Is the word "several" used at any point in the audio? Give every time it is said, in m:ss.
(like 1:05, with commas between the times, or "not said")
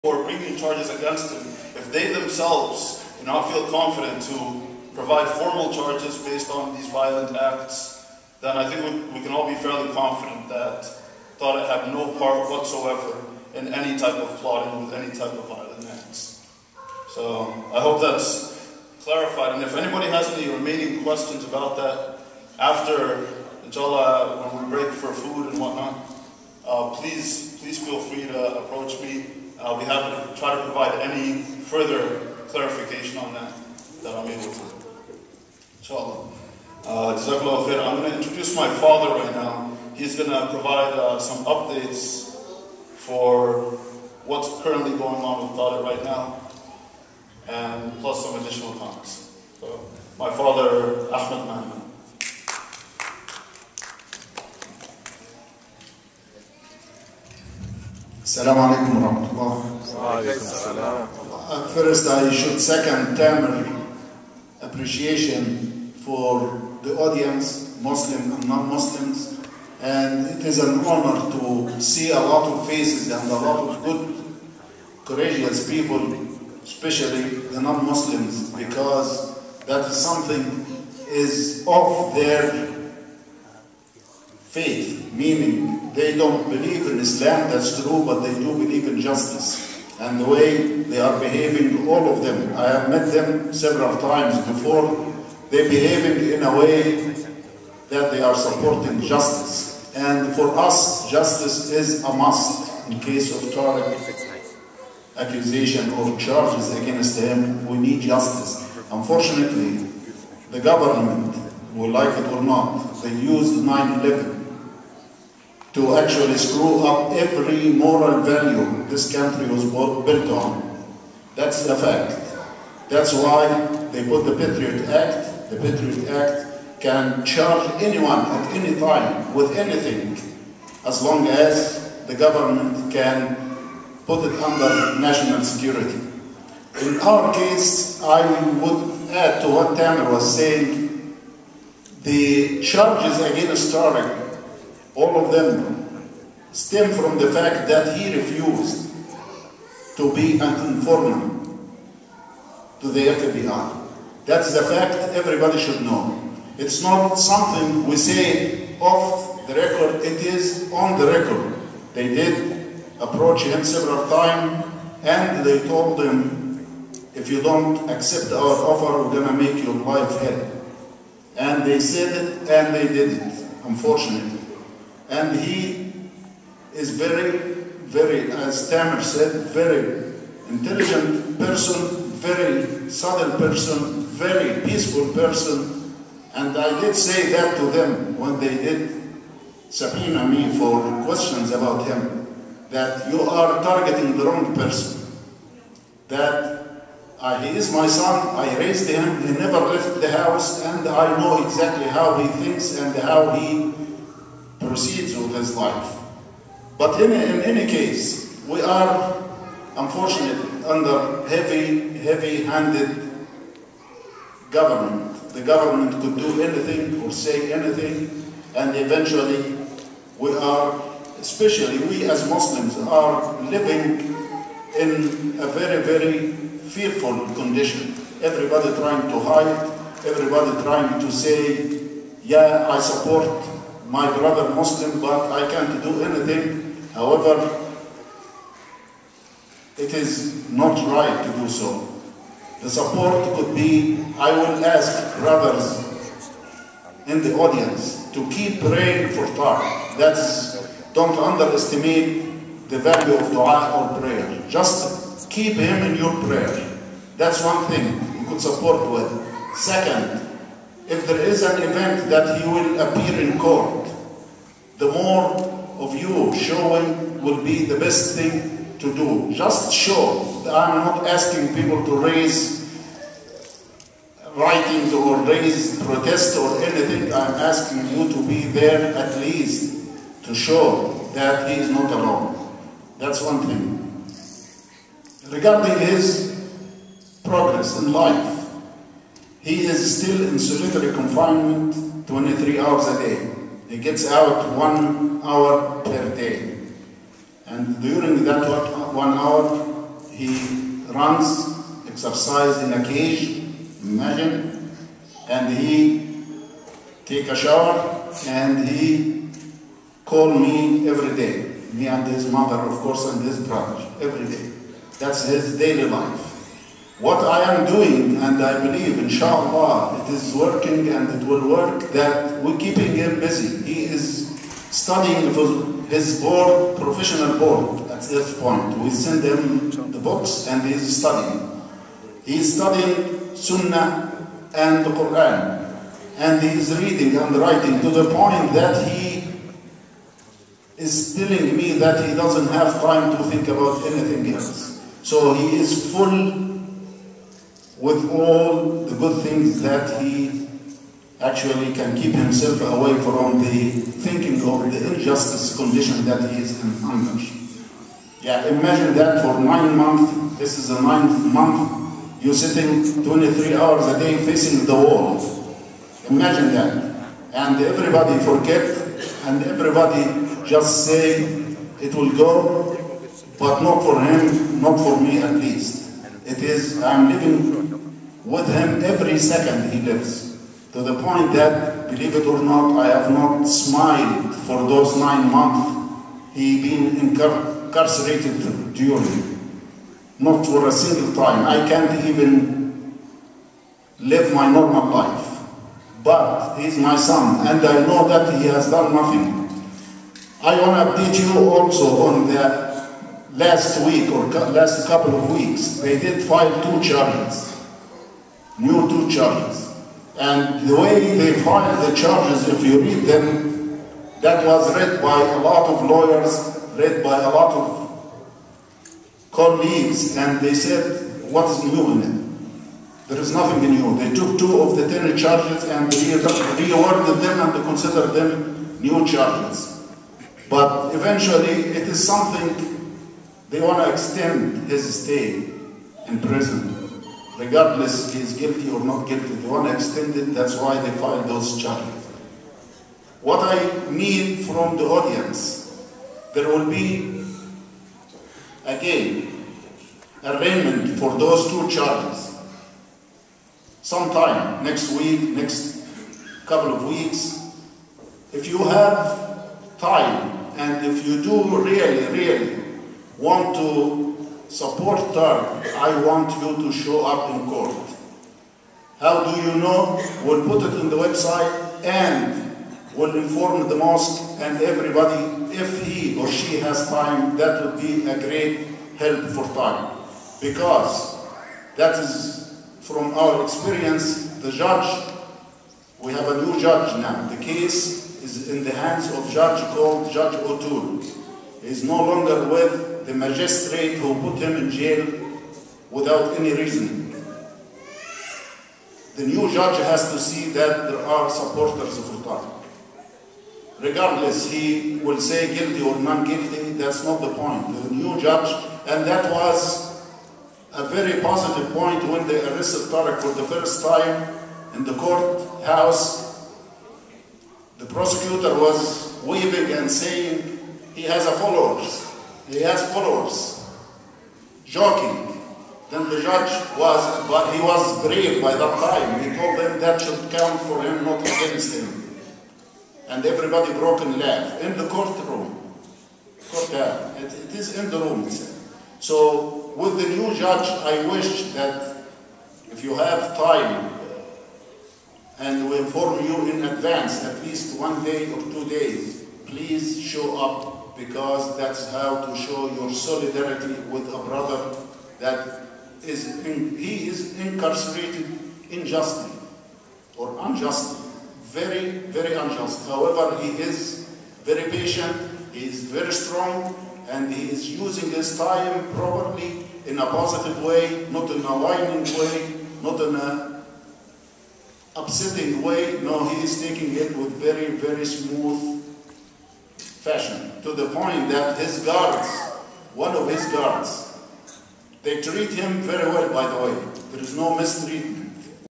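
1:33, 2:43.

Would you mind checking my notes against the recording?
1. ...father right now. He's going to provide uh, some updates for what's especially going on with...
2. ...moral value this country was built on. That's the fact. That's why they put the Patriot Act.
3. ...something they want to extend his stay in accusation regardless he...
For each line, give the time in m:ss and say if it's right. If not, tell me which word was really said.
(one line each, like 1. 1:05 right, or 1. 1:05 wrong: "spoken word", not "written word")
1. 0:38 wrong: "currently", not "especially"
2. 1:57 right
3. 7:12 wrong: "prison", not "accusation".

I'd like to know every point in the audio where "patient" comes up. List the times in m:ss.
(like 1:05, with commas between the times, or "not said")
9:24.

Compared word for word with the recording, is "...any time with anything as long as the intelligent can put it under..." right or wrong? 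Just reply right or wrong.
wrong.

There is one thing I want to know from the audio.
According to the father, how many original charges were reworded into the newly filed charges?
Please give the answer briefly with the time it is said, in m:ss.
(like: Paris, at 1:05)
10, at 7:04.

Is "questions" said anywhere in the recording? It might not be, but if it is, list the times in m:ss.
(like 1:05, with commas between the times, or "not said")
0:21, 3:11.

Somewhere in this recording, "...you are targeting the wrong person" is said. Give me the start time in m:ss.
3:13.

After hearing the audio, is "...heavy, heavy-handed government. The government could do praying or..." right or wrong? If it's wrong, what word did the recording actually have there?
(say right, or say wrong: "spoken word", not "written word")
wrong: "anything", not "praying".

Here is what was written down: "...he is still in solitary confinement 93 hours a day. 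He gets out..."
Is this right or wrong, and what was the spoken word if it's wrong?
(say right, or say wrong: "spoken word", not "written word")
wrong: "23", not "93".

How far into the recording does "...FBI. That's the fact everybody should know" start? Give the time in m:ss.
2:33.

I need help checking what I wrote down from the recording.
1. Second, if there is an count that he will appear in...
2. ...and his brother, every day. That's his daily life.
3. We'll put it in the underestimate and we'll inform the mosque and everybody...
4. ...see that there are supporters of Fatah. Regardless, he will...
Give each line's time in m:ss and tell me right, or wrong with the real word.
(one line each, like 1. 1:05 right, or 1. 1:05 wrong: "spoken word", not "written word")
1. 4:19 wrong: "event", not "count"
2. 5:13 right
3. 7:50 wrong: "website", not "underestimate"
4. 8:20 right.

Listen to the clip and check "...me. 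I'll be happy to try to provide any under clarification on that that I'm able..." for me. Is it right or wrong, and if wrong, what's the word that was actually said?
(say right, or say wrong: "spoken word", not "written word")
wrong: "further", not "under".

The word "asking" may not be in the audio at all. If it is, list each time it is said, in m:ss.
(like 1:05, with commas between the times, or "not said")
4:31, 4:37.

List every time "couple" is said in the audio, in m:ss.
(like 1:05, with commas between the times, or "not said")
6:44, 7:36.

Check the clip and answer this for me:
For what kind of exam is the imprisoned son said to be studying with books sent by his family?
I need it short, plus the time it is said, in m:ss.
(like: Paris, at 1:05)
professional board, at 5:26.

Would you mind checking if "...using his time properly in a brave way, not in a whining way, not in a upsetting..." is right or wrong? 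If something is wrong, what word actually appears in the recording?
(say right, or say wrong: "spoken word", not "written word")
wrong: "positive", not "brave".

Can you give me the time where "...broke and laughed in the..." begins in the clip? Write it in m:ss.
8:53.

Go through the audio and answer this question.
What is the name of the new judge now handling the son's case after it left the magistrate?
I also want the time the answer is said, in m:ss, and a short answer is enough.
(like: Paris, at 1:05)
Judge O'Toole, at 8:10.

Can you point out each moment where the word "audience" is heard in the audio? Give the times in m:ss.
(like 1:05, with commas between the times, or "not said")
1:06, 4:07, 7:24.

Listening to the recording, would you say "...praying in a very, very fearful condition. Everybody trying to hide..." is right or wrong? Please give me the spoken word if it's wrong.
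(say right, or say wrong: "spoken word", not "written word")
wrong: "living", not "praying".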